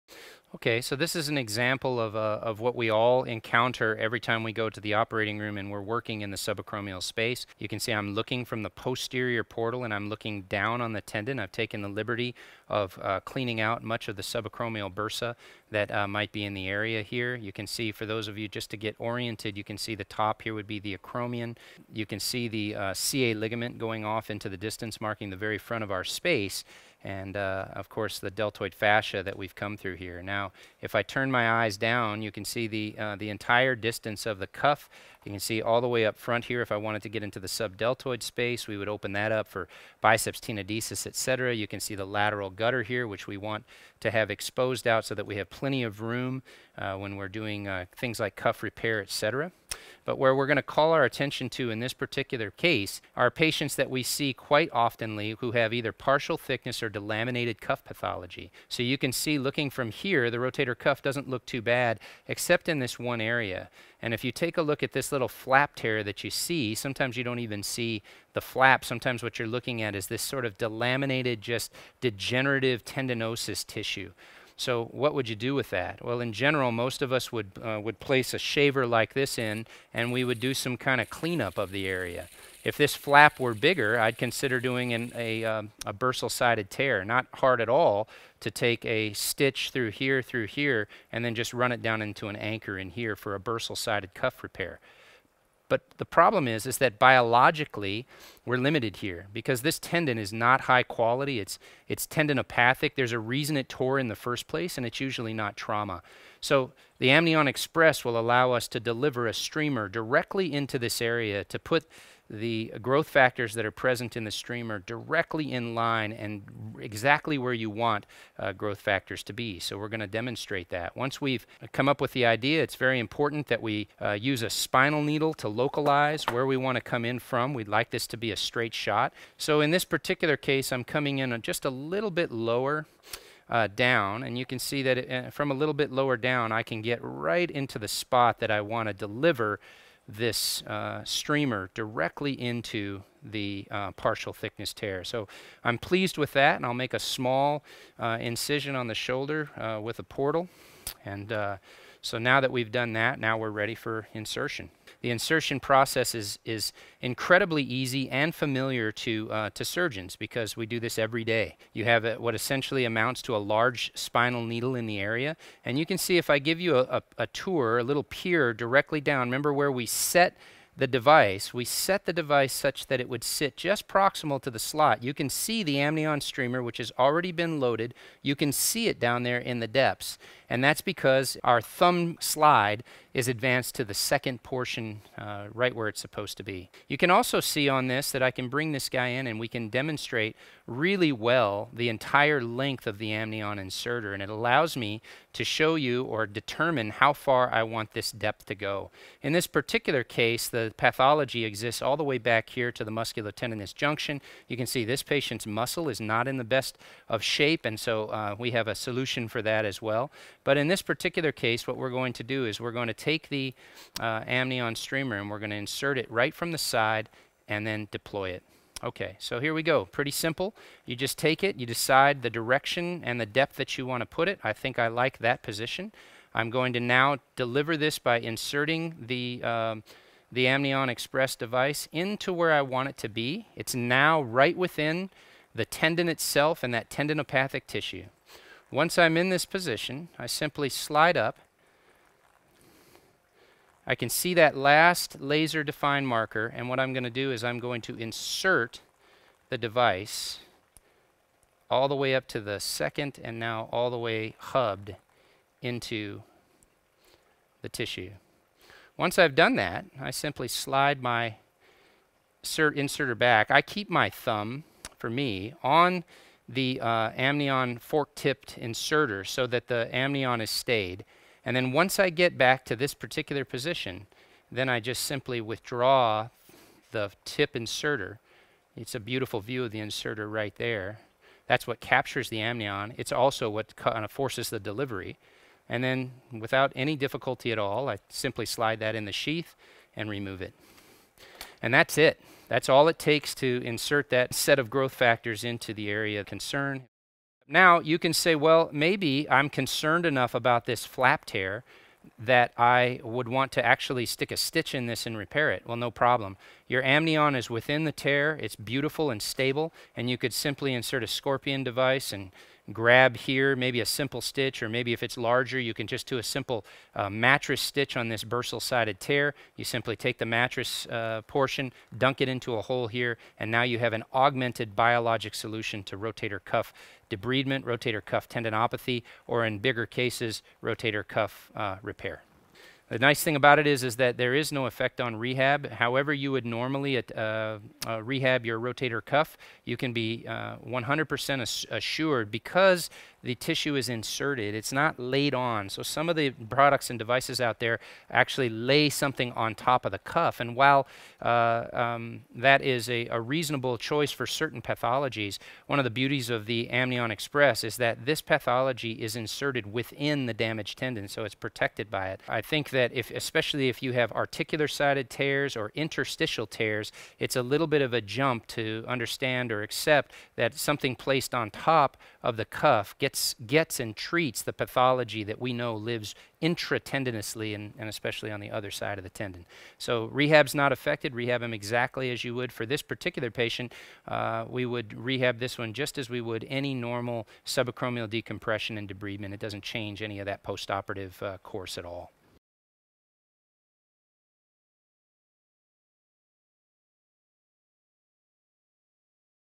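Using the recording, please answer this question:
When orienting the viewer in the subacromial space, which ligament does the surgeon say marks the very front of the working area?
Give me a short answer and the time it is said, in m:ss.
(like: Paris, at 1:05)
CA ligament, at 0:22.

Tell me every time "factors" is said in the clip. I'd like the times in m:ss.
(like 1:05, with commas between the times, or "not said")
1:53, 1:58, 4:54.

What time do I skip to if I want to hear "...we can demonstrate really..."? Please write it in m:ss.
3:09.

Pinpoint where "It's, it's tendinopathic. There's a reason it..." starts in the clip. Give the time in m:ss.
1:41.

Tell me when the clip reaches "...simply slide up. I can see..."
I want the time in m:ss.
4:00.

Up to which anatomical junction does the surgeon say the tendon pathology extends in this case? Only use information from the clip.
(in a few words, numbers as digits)
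musculotendinous junction.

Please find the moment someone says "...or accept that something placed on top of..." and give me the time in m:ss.
6:09.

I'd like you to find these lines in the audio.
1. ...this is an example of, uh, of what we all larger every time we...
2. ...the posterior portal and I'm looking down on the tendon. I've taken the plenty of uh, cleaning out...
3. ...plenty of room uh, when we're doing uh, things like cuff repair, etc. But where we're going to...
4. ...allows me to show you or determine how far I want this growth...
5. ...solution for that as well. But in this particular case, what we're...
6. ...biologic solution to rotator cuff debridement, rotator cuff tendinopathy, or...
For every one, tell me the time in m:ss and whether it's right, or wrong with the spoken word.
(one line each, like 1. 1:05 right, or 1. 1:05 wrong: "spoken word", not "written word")
1. 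0:00 wrong: "encounter", not "larger"
2. 0:08 wrong: "liberty", not "plenty"
3. 0:45 right
4. 3:14 wrong: "depth", not "growth"
5. 3:28 right
6. 5:24 right.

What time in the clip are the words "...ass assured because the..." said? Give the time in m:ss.
5:41.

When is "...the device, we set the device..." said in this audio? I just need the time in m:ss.
2:50.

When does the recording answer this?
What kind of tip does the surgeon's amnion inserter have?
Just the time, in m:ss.
4:27.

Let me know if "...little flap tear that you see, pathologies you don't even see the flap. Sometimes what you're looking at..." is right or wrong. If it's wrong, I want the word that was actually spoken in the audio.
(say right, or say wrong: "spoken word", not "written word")
wrong: "sometimes", not "pathologies".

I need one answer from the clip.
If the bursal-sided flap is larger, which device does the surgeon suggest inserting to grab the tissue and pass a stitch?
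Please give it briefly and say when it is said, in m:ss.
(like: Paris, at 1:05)
scorpion device, at 5:11.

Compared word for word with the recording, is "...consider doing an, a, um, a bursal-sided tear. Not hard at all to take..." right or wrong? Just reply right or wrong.
right.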